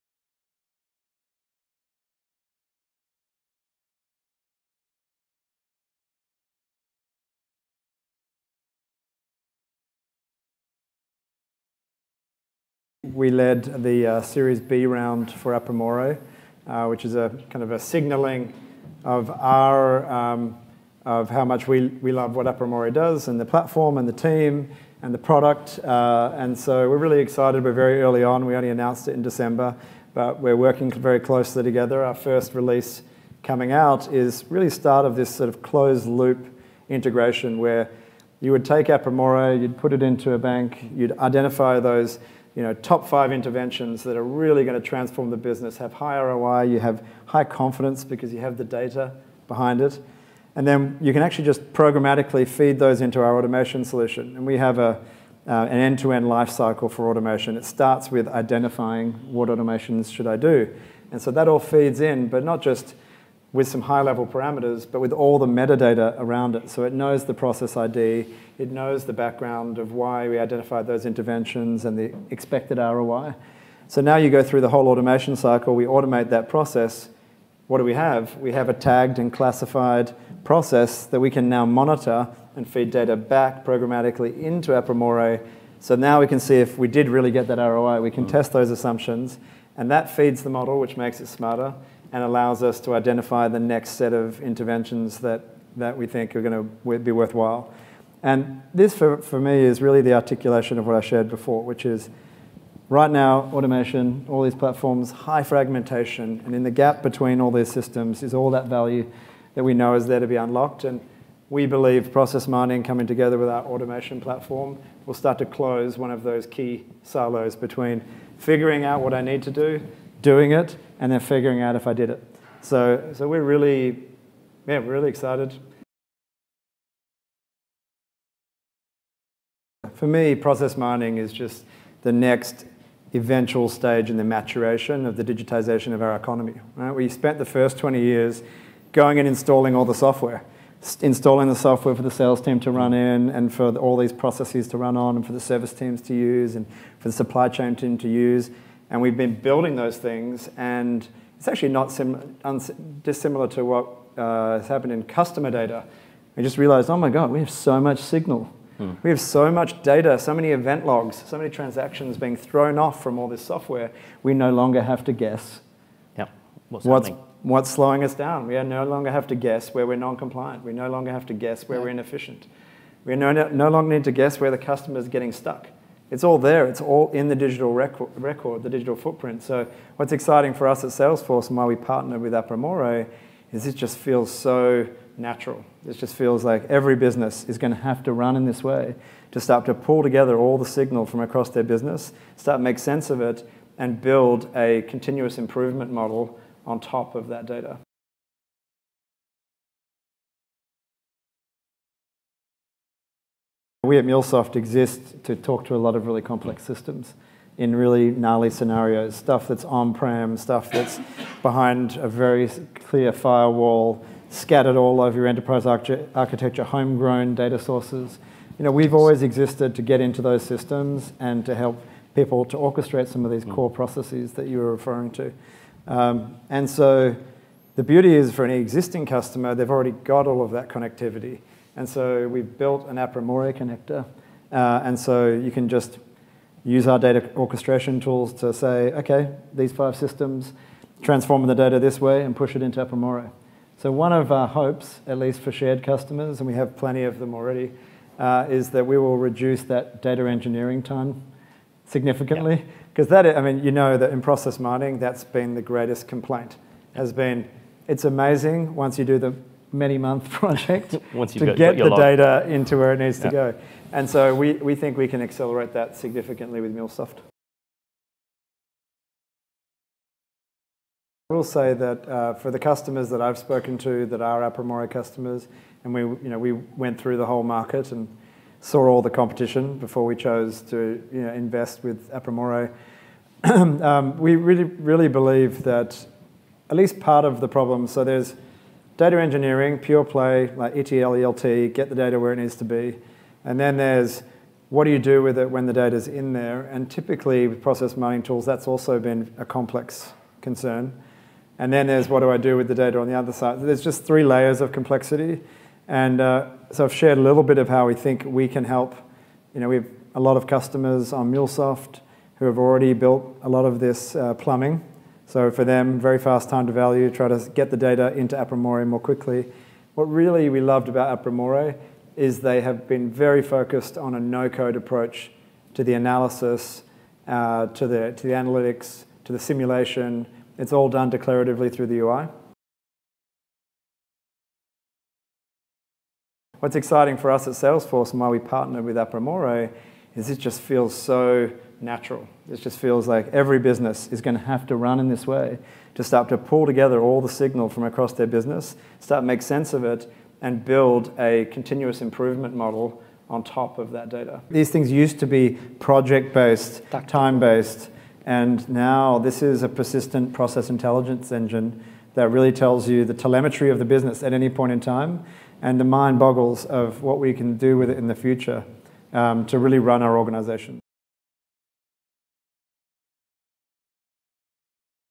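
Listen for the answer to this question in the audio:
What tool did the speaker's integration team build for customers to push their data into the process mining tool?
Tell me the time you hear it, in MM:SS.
03:52.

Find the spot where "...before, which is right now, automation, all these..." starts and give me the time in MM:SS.
01:41.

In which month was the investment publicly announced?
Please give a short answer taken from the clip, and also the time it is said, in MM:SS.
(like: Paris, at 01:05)
December, at 00:29.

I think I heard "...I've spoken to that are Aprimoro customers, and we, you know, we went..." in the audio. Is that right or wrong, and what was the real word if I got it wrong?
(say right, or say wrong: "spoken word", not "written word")
right.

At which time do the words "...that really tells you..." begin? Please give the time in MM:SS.
06:02.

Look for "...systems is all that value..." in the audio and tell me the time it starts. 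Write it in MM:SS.
01:47.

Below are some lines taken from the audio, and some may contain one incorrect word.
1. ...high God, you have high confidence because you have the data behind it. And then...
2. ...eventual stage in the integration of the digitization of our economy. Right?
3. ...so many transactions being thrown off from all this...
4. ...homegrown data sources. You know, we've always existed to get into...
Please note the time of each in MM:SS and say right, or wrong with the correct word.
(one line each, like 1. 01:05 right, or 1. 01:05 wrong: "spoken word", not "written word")
1. 00:45 wrong: "ROI", not "God"
2. 02:13 wrong: "maturation", not "integration"
3. 02:41 right
4. 03:36 right.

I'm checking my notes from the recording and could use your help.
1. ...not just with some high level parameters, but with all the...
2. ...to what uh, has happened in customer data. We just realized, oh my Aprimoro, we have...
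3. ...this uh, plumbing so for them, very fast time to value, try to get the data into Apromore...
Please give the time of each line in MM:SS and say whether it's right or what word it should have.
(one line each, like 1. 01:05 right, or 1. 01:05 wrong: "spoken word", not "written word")
1. 01:02 right
2. 02:33 wrong: "God", not "Aprimoro"
3. 05:13 right.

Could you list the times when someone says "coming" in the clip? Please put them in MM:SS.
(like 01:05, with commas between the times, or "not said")
00:33, 01:52.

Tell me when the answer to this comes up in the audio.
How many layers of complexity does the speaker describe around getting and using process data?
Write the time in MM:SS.
05:04.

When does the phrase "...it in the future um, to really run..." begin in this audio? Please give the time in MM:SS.
06:07.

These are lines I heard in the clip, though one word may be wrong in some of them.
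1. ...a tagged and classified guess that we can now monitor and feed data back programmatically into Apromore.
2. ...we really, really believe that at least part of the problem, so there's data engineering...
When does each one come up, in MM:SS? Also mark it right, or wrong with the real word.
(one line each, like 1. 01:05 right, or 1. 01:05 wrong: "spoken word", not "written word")
1. 01:18 wrong: "process", not "guess"
2. 04:44 right.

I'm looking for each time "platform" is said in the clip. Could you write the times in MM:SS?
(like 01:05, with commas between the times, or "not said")
00:23, 01:44, 01:54.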